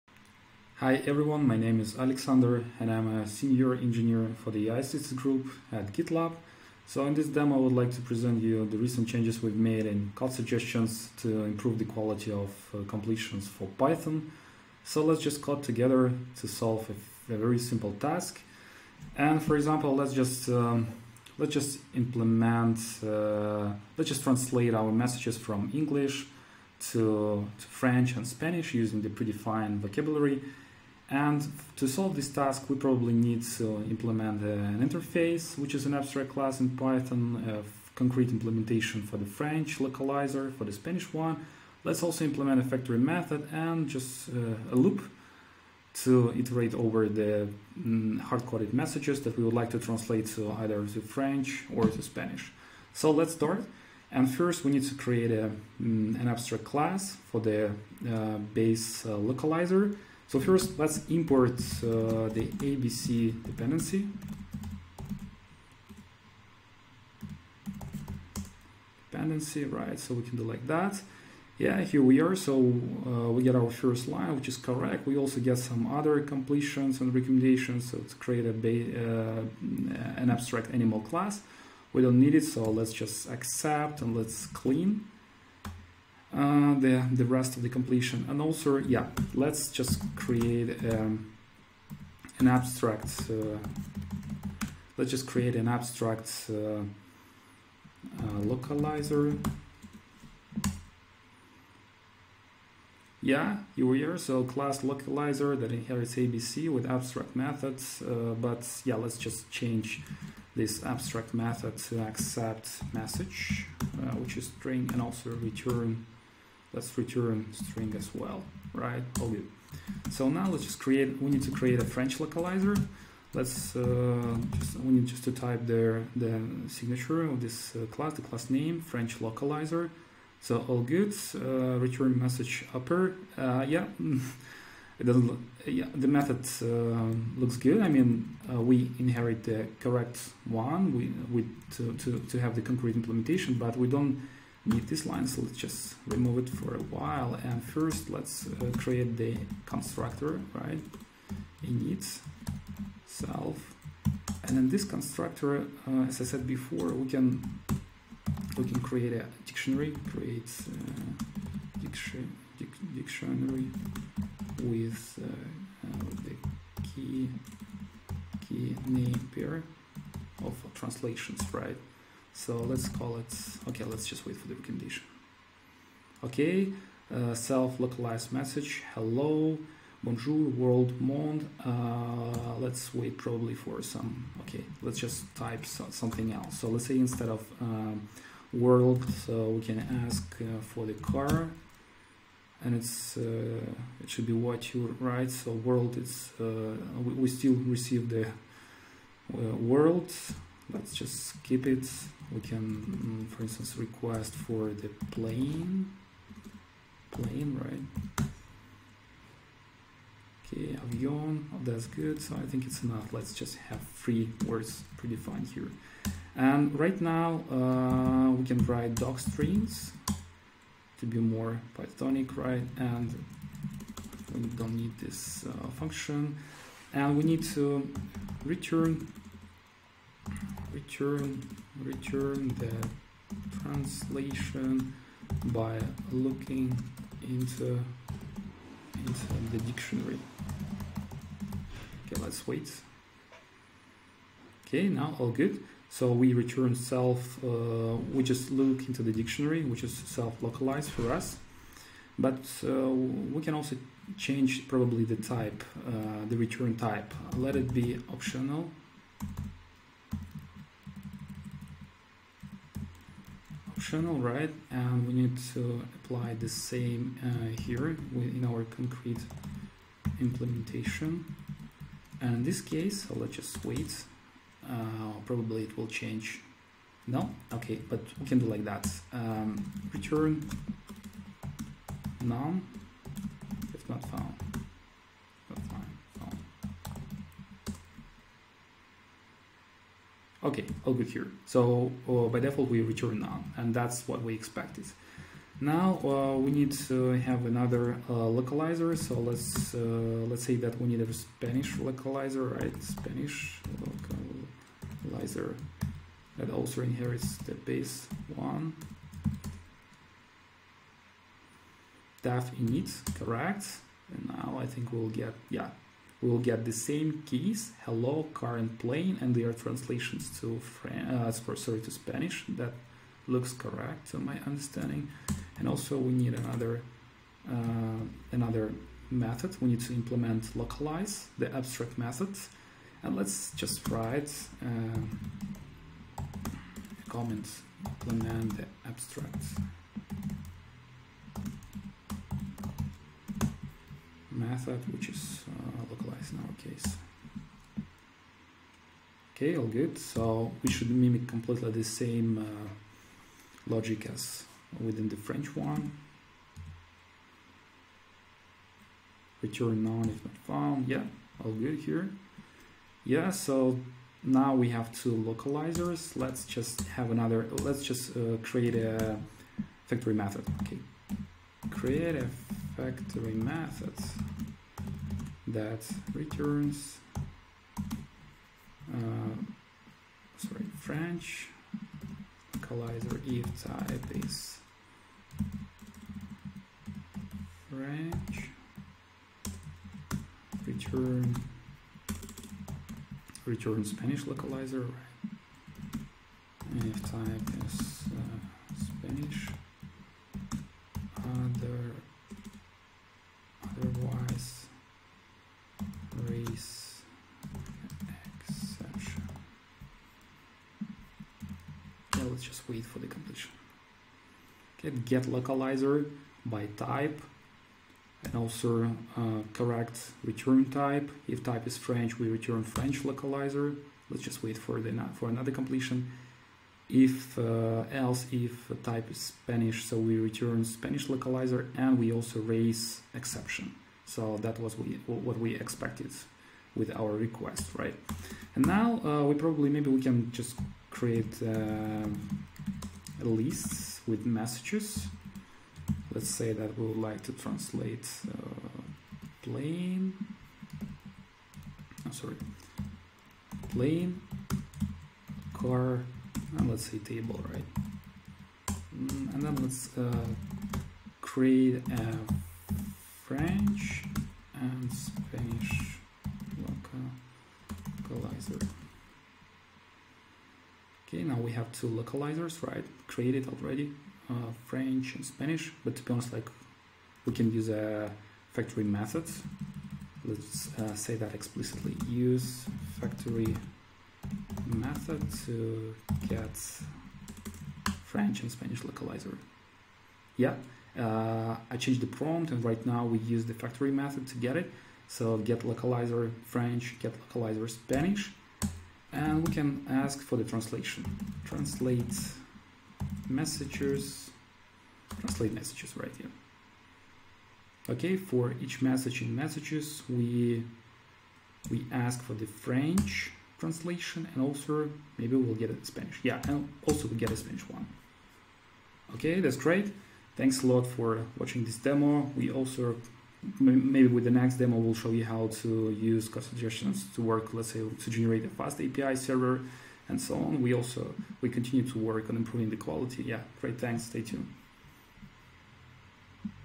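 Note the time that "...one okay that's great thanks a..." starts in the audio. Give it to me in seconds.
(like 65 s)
517 s.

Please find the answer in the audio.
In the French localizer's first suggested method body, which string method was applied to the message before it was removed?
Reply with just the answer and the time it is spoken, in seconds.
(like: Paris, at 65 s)
upper, at 132 s.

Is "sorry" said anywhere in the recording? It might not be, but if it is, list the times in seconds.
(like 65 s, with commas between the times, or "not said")
321 s, 380 s, 452 s.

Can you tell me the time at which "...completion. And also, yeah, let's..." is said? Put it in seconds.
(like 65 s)
87 s.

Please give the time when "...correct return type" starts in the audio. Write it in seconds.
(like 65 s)
419 s.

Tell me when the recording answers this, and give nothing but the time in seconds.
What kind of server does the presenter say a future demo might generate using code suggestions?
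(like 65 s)
528 s.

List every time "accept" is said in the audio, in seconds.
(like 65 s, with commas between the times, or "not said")
83 s, 112 s.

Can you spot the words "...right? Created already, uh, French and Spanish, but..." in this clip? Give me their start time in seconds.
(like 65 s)
472 s.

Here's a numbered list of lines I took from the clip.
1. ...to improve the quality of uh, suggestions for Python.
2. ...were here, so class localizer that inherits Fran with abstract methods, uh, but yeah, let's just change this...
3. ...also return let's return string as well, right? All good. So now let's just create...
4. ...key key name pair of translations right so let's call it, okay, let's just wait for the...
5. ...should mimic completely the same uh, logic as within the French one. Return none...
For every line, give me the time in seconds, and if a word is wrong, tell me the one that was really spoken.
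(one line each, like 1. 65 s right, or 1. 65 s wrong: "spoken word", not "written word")
1. 11 s wrong: "completions", not "suggestions"
2. 103 s wrong: "ABC", not "Fran"
3. 115 s right
4. 166 s right
5. 350 s right.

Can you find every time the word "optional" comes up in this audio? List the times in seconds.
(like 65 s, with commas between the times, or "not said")
258 s.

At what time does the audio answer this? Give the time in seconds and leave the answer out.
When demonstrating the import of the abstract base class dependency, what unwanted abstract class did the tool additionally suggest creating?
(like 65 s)
80 s.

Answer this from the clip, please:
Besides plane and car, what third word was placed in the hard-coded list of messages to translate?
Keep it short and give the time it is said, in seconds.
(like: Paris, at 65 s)
table, at 456 s.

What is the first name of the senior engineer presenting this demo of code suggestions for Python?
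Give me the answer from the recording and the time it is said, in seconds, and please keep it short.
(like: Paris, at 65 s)
Alexander, at 1 s.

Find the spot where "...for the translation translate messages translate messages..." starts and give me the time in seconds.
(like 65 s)
500 s.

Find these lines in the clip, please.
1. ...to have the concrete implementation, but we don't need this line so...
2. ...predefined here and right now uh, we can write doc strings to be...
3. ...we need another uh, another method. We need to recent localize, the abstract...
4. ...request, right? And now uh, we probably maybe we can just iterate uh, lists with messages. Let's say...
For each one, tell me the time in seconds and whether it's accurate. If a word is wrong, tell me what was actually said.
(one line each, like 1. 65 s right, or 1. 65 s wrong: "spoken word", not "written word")
1. 142 s right
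2. 214 s right
3. 325 s wrong: "implement", not "recent"
4. 437 s wrong: "create", not "iterate".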